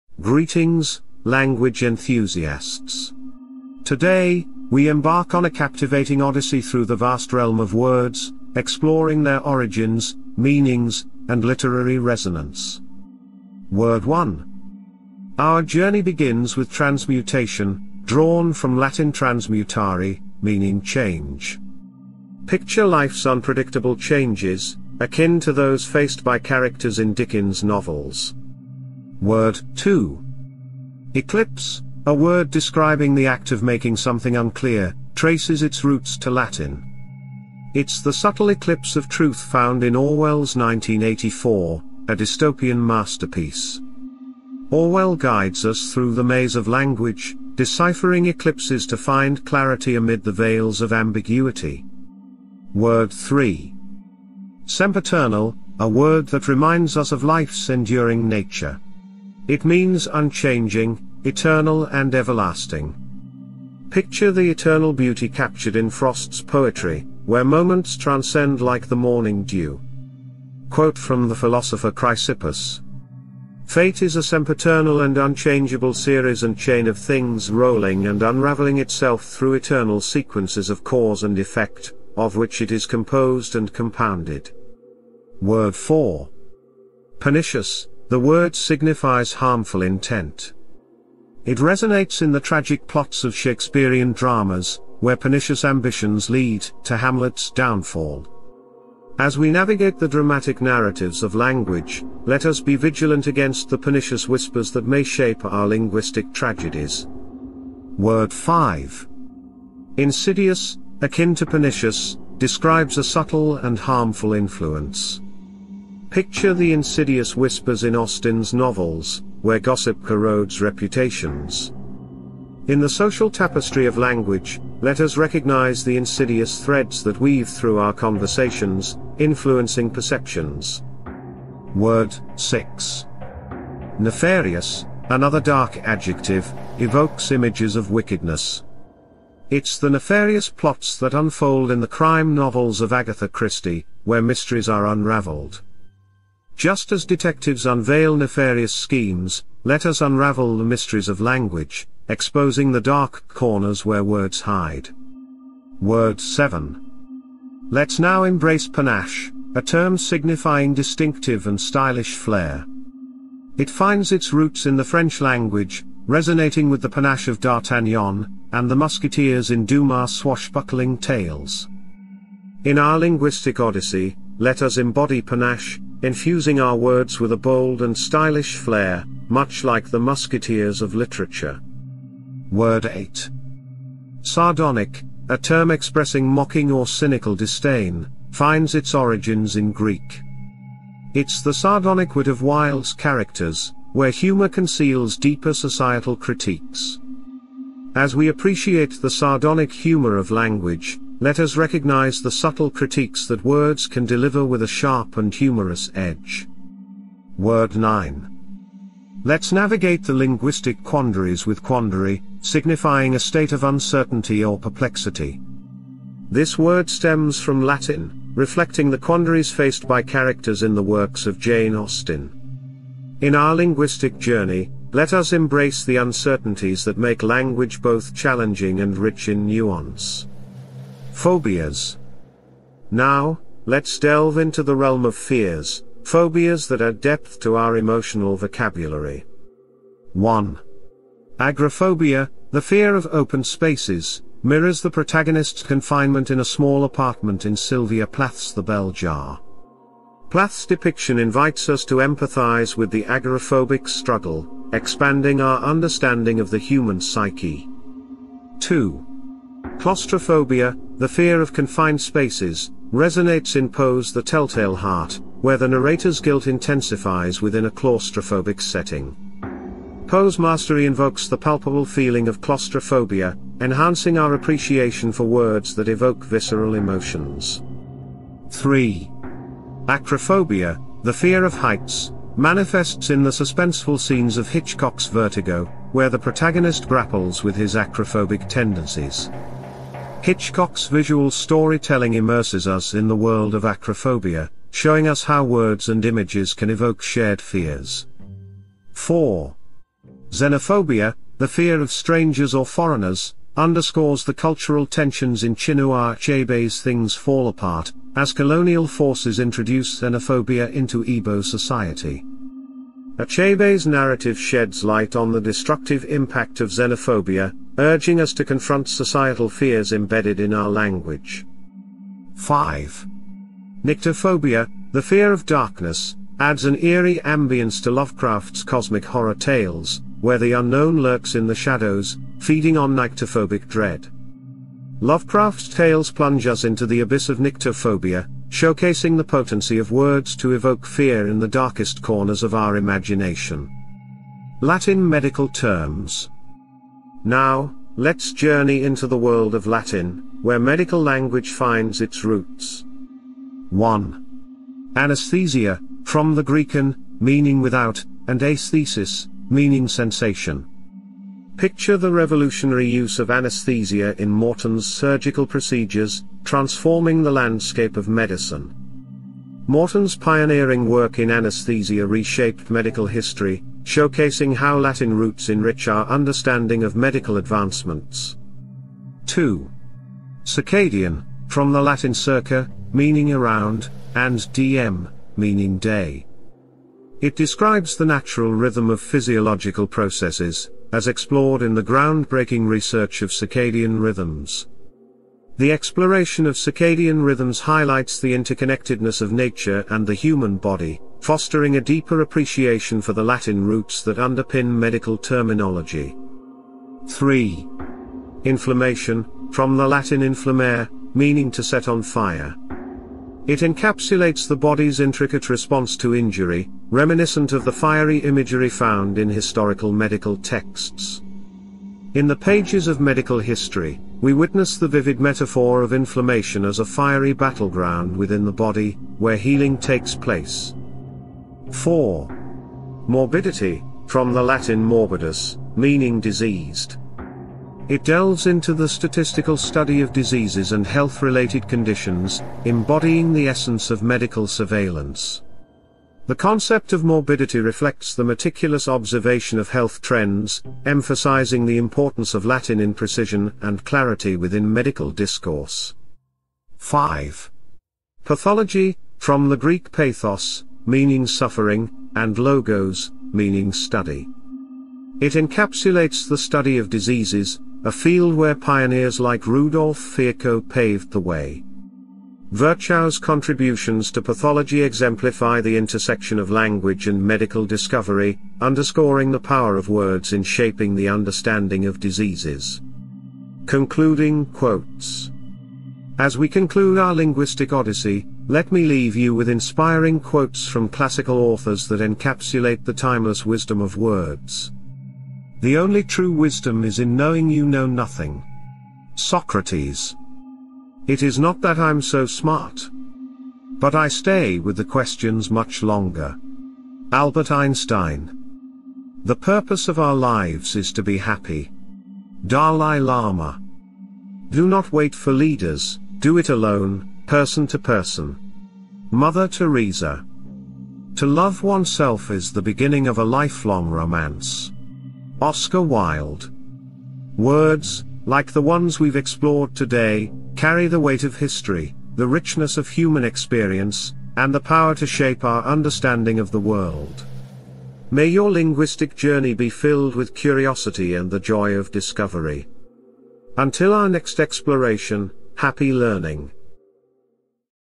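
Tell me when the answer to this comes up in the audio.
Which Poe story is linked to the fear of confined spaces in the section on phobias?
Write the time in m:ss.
4:24.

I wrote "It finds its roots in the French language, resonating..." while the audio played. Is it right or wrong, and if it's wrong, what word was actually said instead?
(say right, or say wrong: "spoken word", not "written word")
right.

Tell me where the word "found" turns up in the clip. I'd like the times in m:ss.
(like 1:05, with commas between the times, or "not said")
0:39, 6:58.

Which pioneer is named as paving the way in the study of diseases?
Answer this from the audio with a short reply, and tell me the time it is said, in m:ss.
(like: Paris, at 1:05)
Rudolf Virchow, at 7:49.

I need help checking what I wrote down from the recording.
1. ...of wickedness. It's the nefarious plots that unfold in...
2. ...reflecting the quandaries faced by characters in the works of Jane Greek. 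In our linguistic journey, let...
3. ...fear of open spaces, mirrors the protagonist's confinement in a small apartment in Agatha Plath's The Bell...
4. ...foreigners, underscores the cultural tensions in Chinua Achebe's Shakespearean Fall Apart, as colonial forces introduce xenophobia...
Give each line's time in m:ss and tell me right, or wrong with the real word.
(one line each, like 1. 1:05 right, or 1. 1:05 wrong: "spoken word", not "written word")
1. 2:17 right
2. 3:38 wrong: "Austen", not "Greek"
3. 4:02 wrong: "Sylvia", not "Agatha"
4. 5:02 wrong: "Things", not "Shakespearean".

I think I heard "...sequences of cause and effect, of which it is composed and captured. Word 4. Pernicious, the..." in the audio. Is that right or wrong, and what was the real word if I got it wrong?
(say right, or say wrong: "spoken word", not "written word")
wrong: "compounded", not "captured".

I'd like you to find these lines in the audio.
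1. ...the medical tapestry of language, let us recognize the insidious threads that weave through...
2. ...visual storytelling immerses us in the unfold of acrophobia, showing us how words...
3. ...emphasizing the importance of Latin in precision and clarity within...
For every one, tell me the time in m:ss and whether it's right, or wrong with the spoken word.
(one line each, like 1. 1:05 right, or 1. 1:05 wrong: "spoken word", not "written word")
1. 2:02 wrong: "social", not "medical"
2. 4:50 wrong: "world", not "unfold"
3. 7:30 right.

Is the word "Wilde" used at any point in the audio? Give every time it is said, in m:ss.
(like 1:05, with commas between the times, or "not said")
3:12, 8:45.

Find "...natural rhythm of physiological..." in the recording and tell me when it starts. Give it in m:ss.
6:28.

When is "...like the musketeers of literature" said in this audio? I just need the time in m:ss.
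2:59.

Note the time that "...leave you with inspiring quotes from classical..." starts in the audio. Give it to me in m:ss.
8:08.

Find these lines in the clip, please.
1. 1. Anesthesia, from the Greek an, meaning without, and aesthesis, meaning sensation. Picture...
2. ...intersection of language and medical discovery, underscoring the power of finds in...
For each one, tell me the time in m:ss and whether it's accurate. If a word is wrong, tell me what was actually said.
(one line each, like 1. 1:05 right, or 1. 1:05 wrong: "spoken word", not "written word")
1. 5:53 right
2. 7:55 wrong: "words", not "finds".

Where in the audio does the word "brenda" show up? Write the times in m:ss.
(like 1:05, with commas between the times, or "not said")
not said.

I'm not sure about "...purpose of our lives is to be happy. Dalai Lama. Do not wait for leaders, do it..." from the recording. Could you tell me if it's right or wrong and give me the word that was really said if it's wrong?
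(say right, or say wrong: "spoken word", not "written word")
right.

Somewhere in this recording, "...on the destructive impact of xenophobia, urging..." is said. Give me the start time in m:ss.
5:15.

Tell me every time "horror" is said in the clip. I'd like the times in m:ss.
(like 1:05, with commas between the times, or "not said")
5:29.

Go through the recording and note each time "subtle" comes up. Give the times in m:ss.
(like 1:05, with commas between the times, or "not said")
0:38, 1:53, 3:22.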